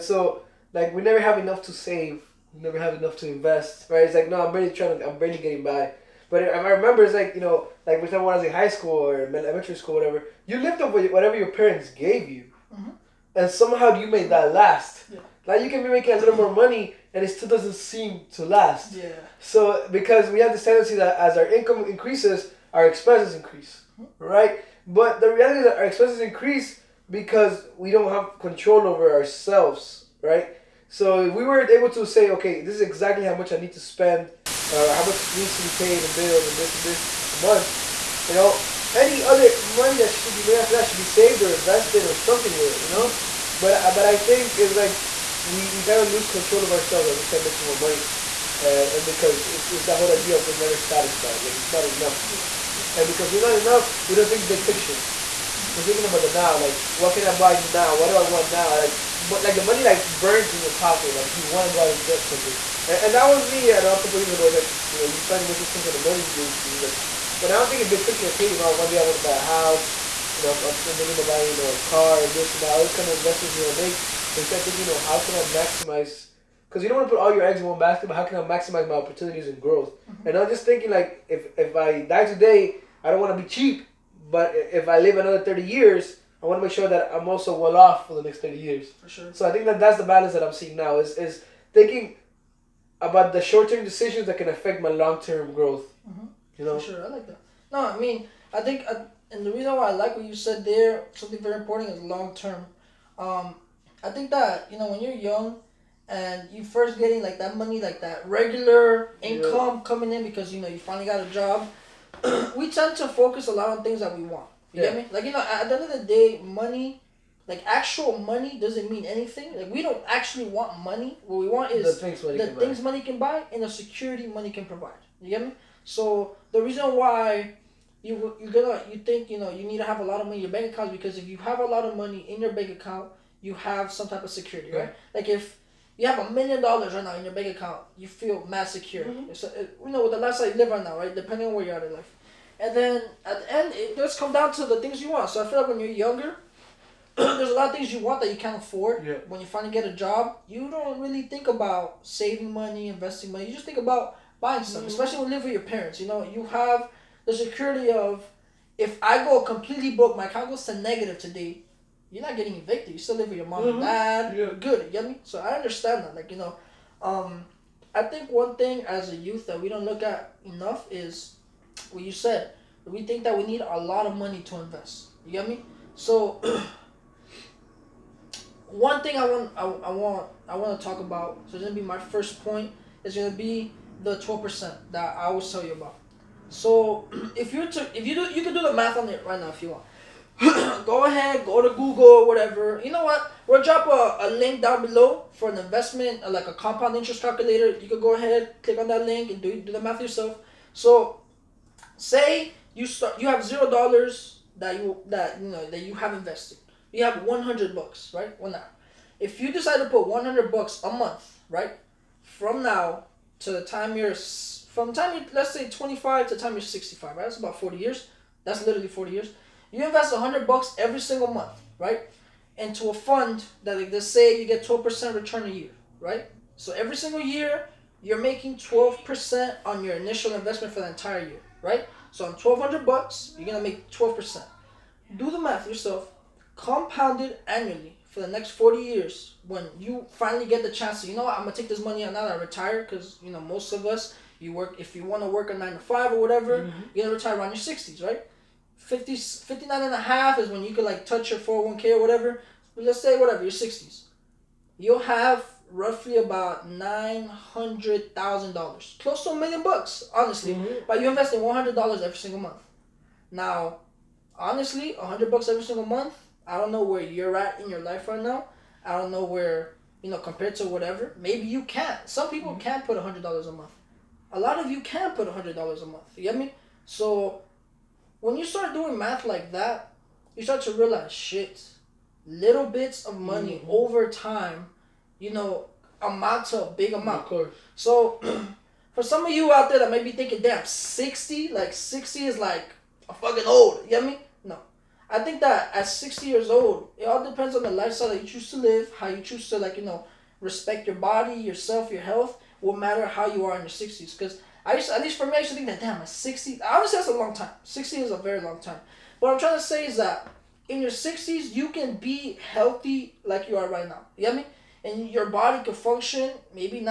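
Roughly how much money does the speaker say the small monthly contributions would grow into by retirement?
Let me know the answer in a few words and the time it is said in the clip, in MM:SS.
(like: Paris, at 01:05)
$900,000, at 04:16.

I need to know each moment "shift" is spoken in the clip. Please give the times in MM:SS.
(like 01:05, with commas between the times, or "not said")
not said.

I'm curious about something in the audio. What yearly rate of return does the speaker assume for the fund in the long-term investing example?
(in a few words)
12%.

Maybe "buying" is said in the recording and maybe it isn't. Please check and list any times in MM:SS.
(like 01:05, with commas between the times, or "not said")
01:11, 02:34.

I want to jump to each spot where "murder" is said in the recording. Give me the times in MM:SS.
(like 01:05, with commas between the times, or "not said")
not said.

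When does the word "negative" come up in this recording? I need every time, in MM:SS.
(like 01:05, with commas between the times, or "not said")
02:40.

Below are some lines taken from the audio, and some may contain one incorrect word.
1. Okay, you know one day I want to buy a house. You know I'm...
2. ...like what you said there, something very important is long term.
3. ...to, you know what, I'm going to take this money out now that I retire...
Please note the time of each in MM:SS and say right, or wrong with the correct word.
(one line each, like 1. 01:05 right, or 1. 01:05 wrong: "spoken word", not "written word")
1. 01:08 right
2. 01:39 right
3. 04:01 right.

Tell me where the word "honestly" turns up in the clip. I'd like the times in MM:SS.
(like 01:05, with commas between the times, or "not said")
04:20, 04:24, 05:06.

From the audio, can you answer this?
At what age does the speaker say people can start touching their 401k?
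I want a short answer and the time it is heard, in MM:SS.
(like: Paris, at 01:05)
59 and a half, at 04:09.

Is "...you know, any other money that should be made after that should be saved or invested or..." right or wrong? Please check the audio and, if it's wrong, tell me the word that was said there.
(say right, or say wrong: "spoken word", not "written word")
right.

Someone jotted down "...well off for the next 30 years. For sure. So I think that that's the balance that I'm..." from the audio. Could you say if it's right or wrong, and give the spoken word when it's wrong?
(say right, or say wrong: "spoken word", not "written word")
right.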